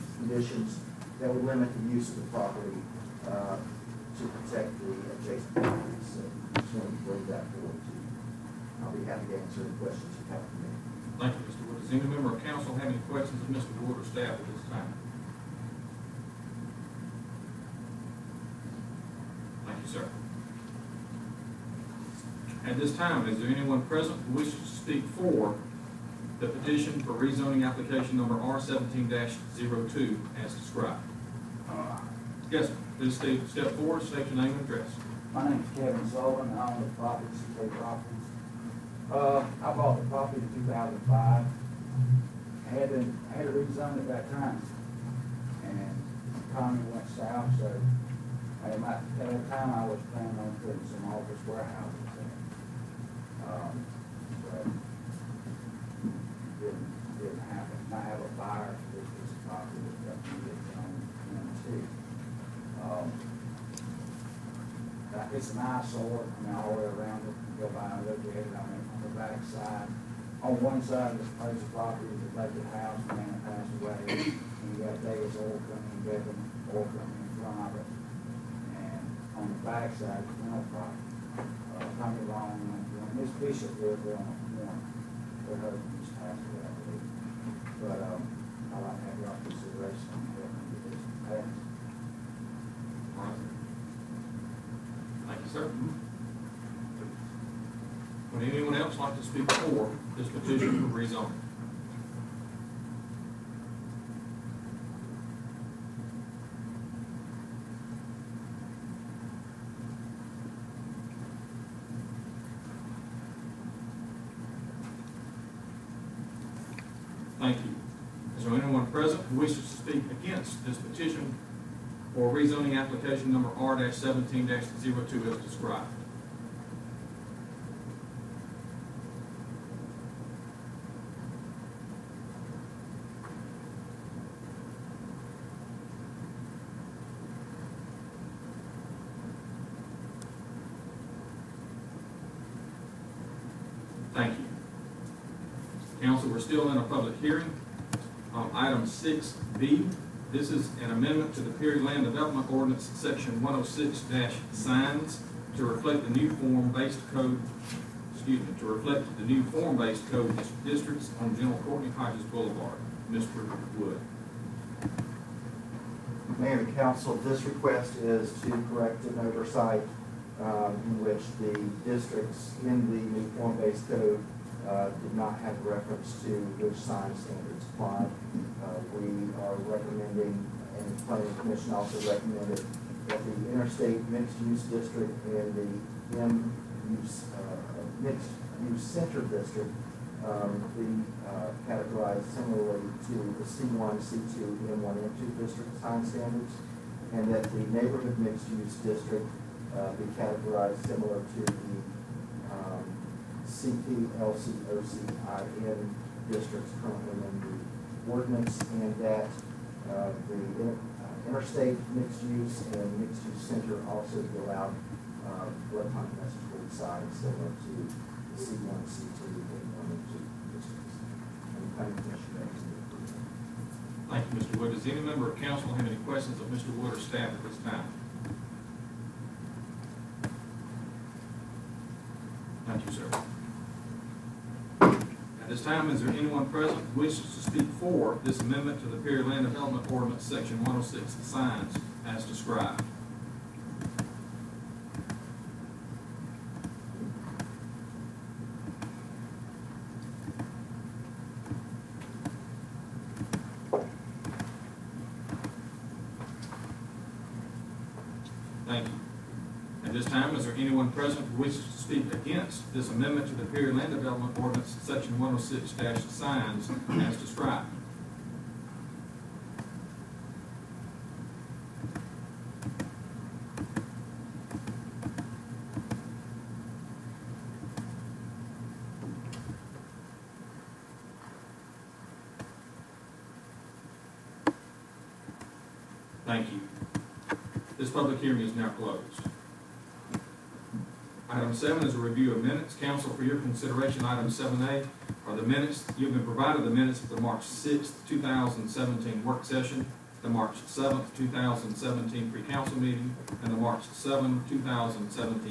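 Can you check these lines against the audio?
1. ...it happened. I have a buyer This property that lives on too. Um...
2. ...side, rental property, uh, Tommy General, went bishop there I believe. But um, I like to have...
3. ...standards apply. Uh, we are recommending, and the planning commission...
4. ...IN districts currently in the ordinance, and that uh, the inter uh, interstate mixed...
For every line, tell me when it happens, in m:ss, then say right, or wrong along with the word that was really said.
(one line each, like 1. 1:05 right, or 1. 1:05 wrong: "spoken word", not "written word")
1. 0:57 right
2. 1:19 wrong: "Long", not "General"
3. 2:57 right
4. 3:25 right.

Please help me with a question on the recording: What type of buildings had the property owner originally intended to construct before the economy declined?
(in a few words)
office warehouses.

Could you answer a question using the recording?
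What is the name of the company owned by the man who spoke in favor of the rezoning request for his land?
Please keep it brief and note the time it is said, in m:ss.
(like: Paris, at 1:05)
CK Properties, at 0:37.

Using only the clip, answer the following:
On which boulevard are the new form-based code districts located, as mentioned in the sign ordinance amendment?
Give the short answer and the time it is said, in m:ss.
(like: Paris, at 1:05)
General Courtney Hodges Boulevard, at 2:41.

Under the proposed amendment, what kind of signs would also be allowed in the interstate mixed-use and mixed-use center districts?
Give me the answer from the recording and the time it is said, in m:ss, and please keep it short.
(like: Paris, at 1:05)
electronic message board signs, at 3:35.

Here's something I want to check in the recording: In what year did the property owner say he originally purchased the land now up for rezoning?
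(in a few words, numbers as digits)
2005.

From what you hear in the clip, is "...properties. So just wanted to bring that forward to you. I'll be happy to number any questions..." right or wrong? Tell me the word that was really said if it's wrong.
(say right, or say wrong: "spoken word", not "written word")
wrong: "answer", not "number".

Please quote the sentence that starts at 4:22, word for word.
ordinance, this amendment to the Perry Land Development Ordinance, section 106 signs as described.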